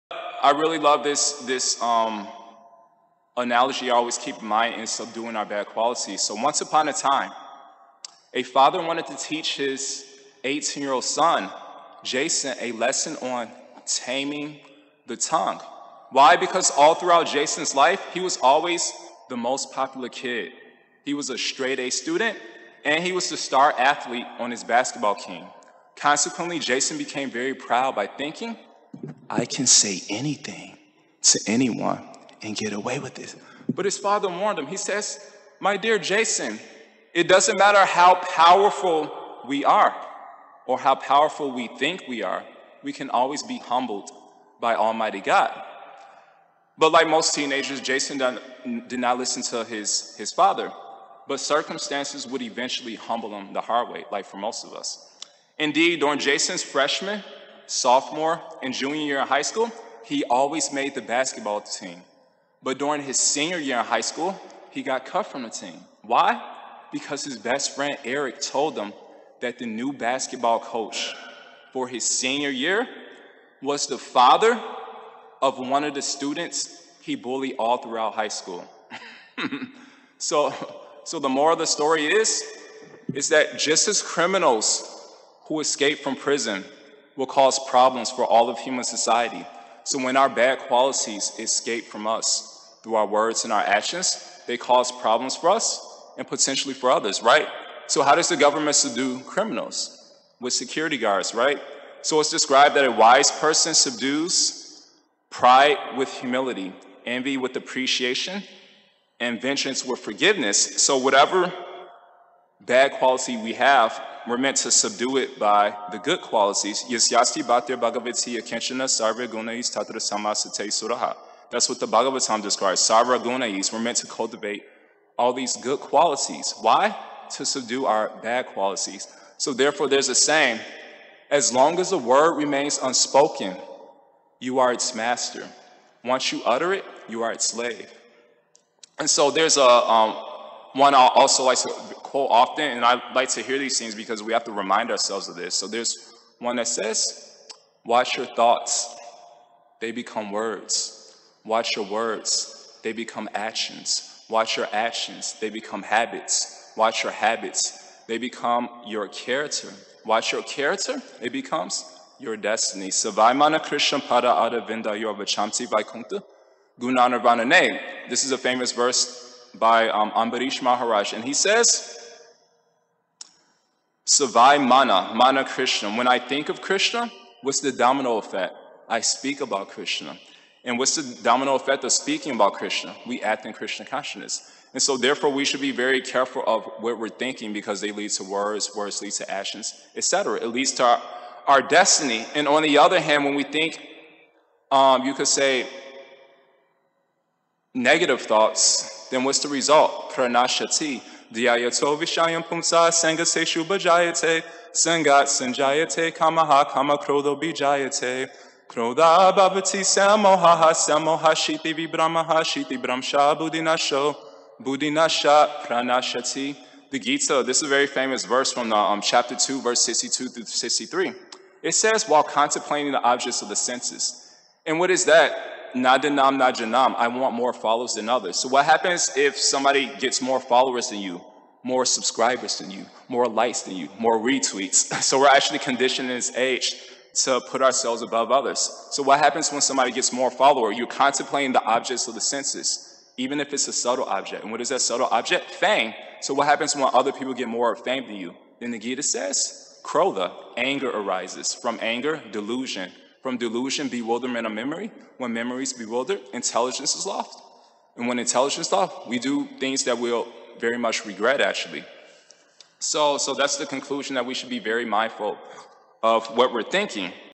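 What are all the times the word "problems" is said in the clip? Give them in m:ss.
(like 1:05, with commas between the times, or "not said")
1:27, 1:34.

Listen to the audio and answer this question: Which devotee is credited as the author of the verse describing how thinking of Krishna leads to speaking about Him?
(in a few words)
Ambarish Maharaj.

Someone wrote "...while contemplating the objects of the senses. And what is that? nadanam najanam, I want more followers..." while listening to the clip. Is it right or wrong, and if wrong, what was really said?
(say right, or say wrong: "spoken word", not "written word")
right.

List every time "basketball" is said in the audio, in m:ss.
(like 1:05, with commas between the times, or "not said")
0:24, 1:01, 1:09.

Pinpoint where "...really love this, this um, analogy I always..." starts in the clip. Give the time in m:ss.
0:00.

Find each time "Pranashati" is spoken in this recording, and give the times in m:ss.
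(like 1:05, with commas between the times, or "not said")
3:20, 3:35.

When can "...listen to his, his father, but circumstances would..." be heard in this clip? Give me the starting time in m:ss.
0:49.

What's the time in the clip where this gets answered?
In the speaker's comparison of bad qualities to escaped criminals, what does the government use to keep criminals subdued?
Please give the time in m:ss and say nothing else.
1:40.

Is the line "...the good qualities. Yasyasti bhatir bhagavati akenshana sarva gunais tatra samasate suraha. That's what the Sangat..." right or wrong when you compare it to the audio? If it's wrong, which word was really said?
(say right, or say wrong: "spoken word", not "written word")
wrong: "Bhagavatam", not "Sangat".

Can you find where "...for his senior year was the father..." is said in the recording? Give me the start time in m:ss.
1:11.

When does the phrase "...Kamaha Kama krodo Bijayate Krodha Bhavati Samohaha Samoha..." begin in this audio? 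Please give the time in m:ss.
3:26.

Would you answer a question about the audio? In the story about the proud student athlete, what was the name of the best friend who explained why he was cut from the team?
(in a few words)
Eric.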